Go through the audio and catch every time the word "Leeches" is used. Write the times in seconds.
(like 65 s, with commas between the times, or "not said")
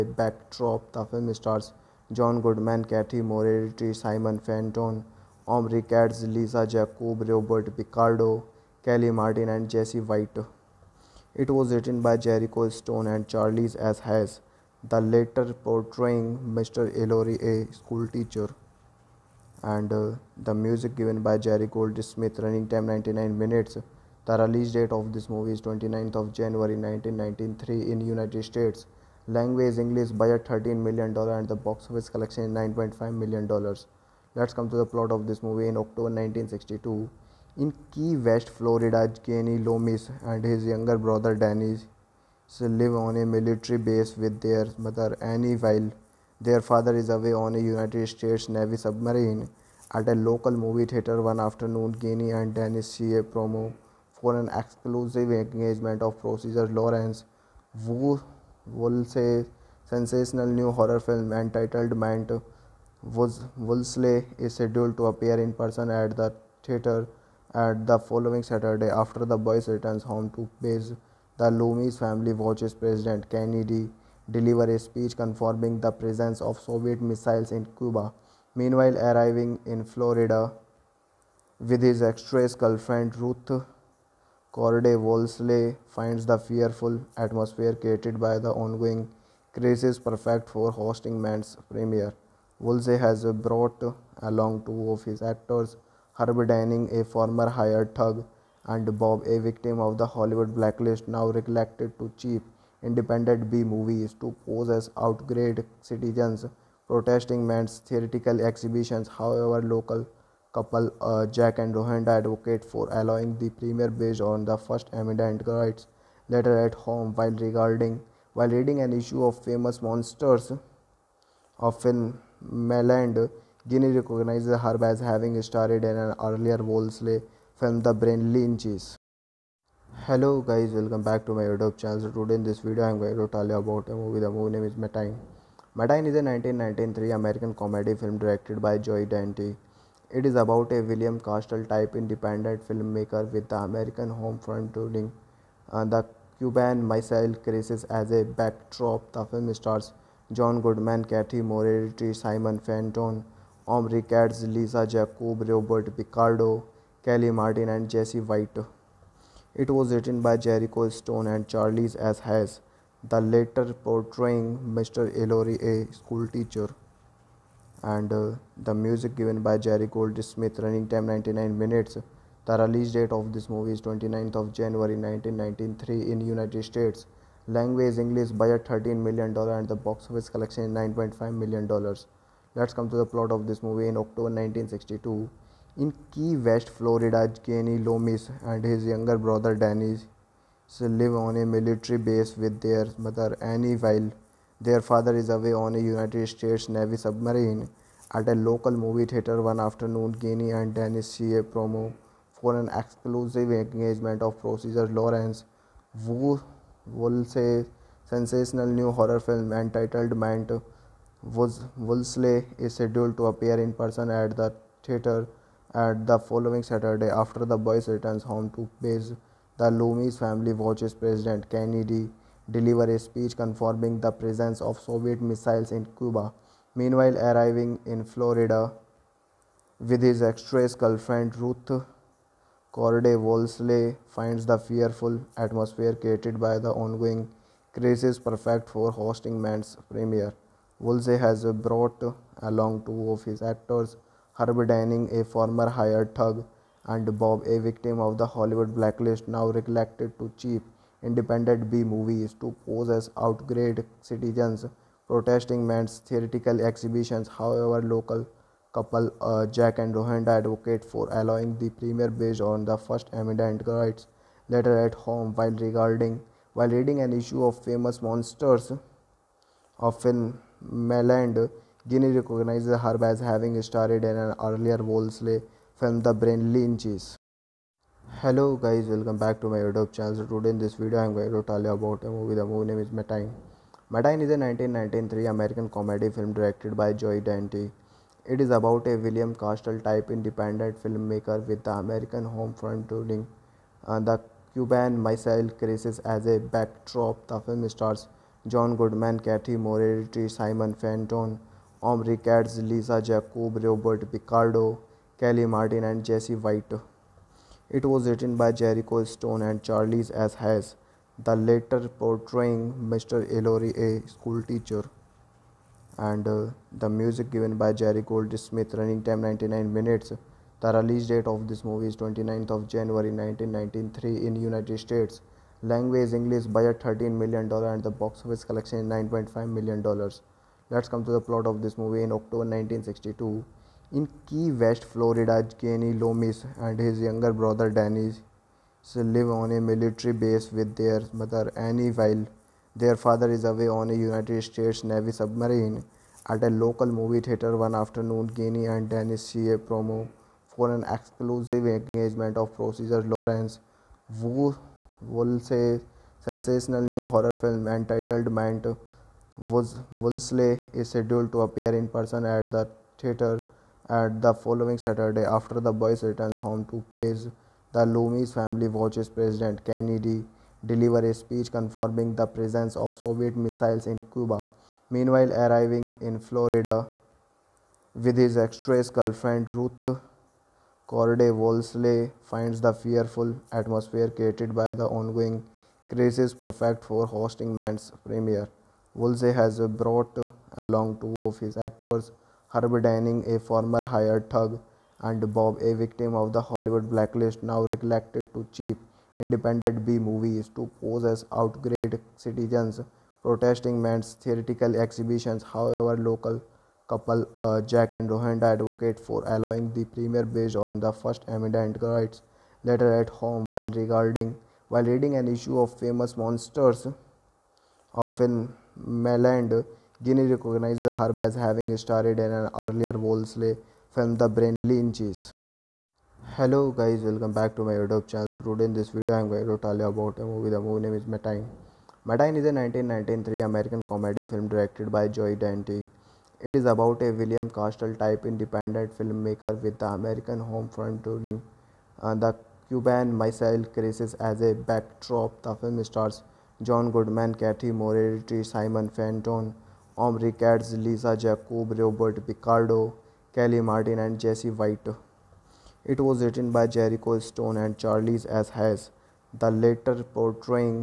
128 s, 276 s, 424 s.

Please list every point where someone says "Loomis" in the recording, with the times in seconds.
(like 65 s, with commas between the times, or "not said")
39 s, 71 s, 187 s, 219 s, 335 s, 367 s.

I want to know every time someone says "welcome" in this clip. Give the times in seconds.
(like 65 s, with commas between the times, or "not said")
130 s, 278 s, 427 s.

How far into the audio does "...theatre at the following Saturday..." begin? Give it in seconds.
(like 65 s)
214 s.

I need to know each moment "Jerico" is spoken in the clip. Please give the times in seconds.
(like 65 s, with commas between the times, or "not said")
12 s, 160 s, 308 s, 456 s.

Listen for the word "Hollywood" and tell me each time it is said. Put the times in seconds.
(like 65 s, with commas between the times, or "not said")
100 s, 248 s, 396 s.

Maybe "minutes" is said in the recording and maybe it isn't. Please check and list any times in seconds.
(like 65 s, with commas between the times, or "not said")
23 s, 171 s, 319 s.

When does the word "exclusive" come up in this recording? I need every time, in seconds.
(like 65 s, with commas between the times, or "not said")
54 s, 202 s, 350 s.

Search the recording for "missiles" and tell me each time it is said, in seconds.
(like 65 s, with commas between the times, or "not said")
76 s, 146 s, 225 s, 295 s, 373 s, 443 s.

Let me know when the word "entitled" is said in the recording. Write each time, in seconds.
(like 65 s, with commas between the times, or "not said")
61 s, 209 s, 357 s.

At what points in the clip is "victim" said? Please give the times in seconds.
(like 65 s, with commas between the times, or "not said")
99 s, 247 s, 395 s.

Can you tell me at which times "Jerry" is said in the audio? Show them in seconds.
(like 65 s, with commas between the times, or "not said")
21 s, 169 s, 317 s.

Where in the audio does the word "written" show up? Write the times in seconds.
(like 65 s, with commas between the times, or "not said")
11 s, 159 s, 308 s, 456 s.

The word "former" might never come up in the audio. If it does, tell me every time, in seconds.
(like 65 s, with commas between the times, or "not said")
97 s, 245 s, 393 s.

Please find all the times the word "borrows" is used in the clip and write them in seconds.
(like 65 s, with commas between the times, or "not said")
not said.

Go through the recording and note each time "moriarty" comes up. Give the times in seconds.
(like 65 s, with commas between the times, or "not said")
3 s, 151 s, 299 s, 447 s.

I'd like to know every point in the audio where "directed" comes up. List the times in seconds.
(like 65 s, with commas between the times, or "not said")
138 s, 286 s, 434 s.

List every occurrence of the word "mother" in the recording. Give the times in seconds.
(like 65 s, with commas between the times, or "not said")
44 s, 192 s, 341 s.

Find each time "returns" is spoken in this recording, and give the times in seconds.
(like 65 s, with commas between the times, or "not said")
69 s, 217 s, 366 s.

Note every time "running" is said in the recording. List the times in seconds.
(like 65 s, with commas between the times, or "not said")
22 s, 170 s, 318 s.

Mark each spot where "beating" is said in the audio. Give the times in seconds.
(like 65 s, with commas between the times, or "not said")
not said.